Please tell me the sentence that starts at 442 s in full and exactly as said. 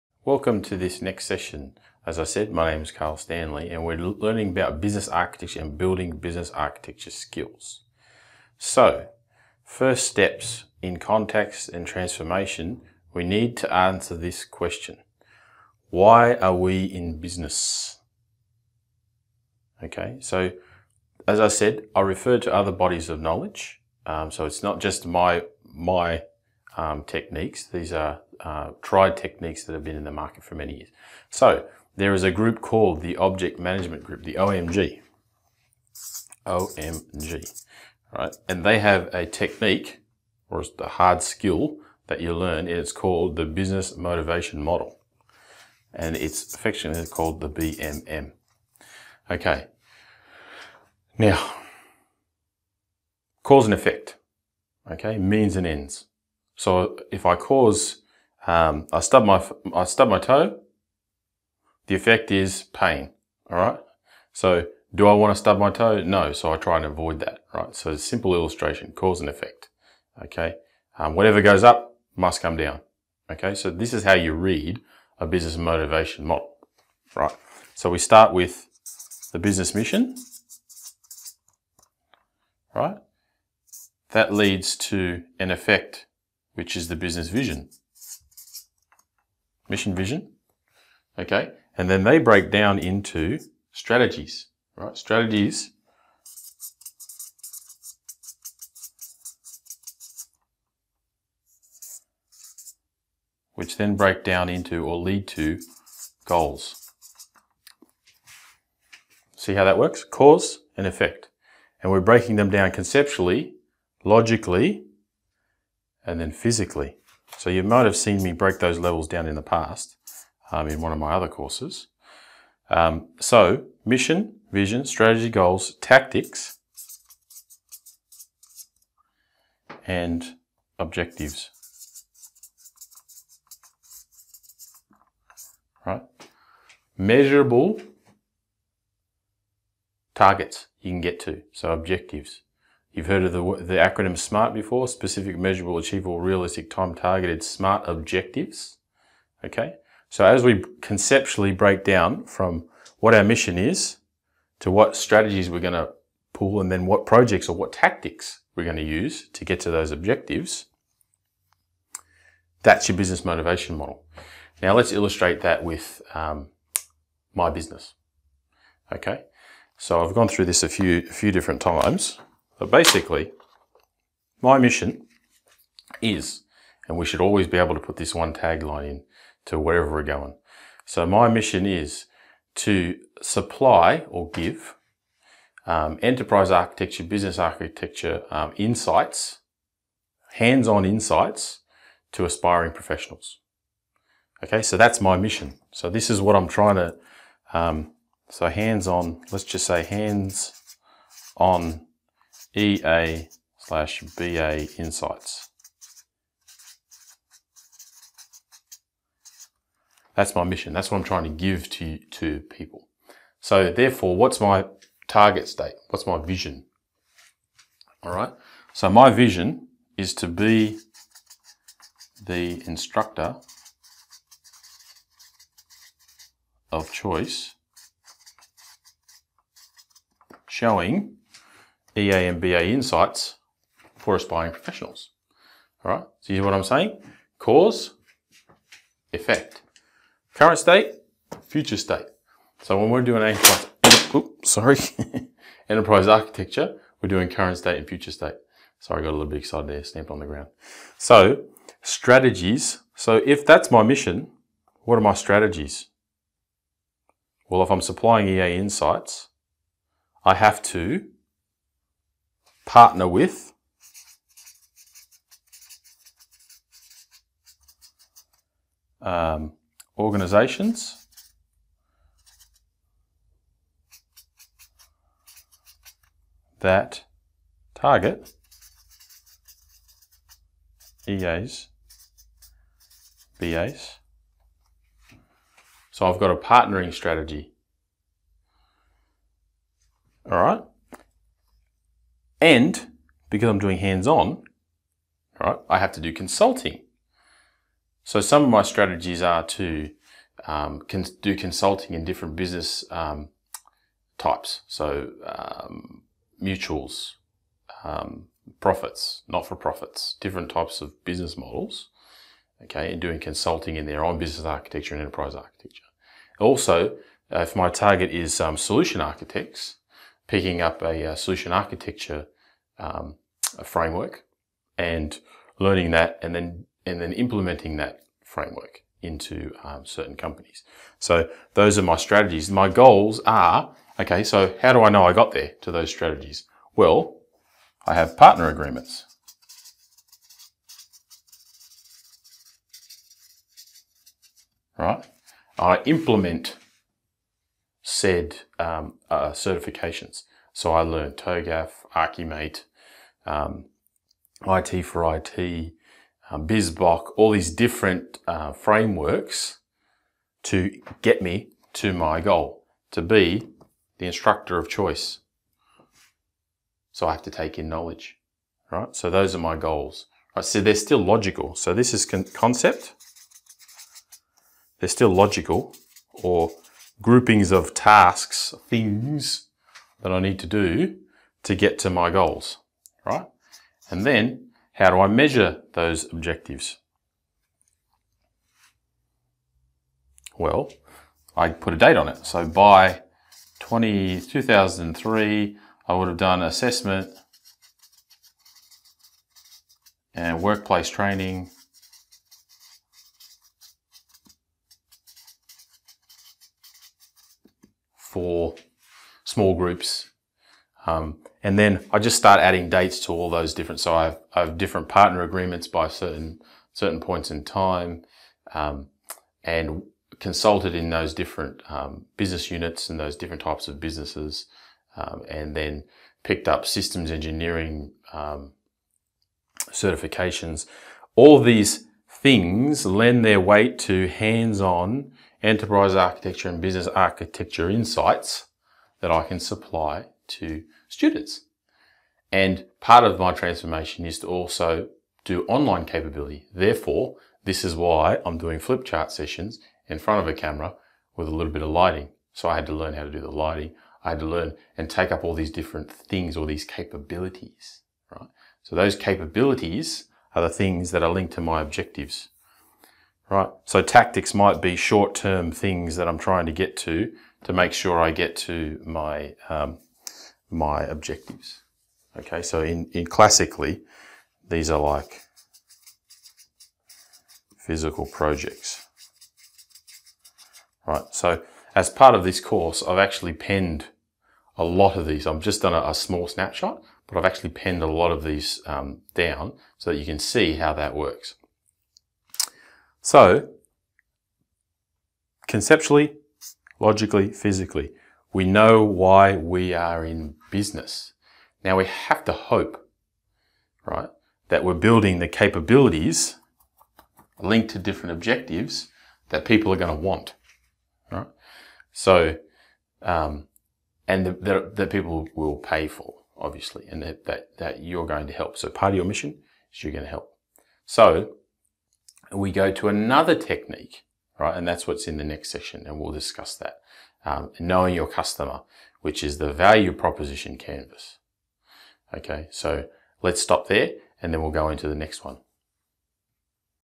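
And part of my transformation is to also do online capability.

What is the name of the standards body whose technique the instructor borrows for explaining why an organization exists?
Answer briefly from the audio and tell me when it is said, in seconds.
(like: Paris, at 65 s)
Object Management Group, at 33 s.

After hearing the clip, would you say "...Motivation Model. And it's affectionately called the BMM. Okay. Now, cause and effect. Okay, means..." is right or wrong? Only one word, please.
right.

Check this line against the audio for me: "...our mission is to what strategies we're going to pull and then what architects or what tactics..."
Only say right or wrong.
wrong.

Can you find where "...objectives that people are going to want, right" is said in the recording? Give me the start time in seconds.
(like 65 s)
508 s.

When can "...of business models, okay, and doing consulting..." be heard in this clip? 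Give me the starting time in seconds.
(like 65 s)
310 s.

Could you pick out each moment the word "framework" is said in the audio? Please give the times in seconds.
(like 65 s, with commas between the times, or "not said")
323 s, 328 s, 358 s.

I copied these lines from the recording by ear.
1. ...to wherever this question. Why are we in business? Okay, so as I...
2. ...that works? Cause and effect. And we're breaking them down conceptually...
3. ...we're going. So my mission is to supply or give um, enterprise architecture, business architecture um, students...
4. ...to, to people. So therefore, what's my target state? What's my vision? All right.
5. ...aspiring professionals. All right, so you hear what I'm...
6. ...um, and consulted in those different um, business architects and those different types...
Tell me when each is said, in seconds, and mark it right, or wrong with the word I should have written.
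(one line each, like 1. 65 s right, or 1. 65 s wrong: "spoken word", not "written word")
1. 13 s wrong: "answer", not "wherever"
2. 109 s right
3. 179 s wrong: "insights", not "students"
4. 211 s right
5. 234 s right
6. 418 s wrong: "units", not "architects".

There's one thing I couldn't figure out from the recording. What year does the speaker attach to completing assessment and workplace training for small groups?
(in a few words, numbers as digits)
2003.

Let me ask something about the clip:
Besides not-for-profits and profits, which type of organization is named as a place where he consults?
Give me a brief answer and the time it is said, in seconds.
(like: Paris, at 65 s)
mutuals, at 306 s.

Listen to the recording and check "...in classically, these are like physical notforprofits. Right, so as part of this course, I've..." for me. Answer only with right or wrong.
wrong.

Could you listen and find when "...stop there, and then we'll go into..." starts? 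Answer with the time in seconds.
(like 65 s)
533 s.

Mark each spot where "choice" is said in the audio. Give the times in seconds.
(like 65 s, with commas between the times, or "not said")
226 s, 364 s.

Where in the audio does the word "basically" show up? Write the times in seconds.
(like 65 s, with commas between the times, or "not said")
172 s.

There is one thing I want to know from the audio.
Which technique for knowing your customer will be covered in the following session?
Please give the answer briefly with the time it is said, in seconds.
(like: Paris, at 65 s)
value proposition canvas, at 529 s.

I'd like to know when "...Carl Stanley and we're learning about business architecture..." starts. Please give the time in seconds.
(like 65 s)
2 s.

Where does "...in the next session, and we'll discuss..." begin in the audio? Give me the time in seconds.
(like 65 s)
525 s.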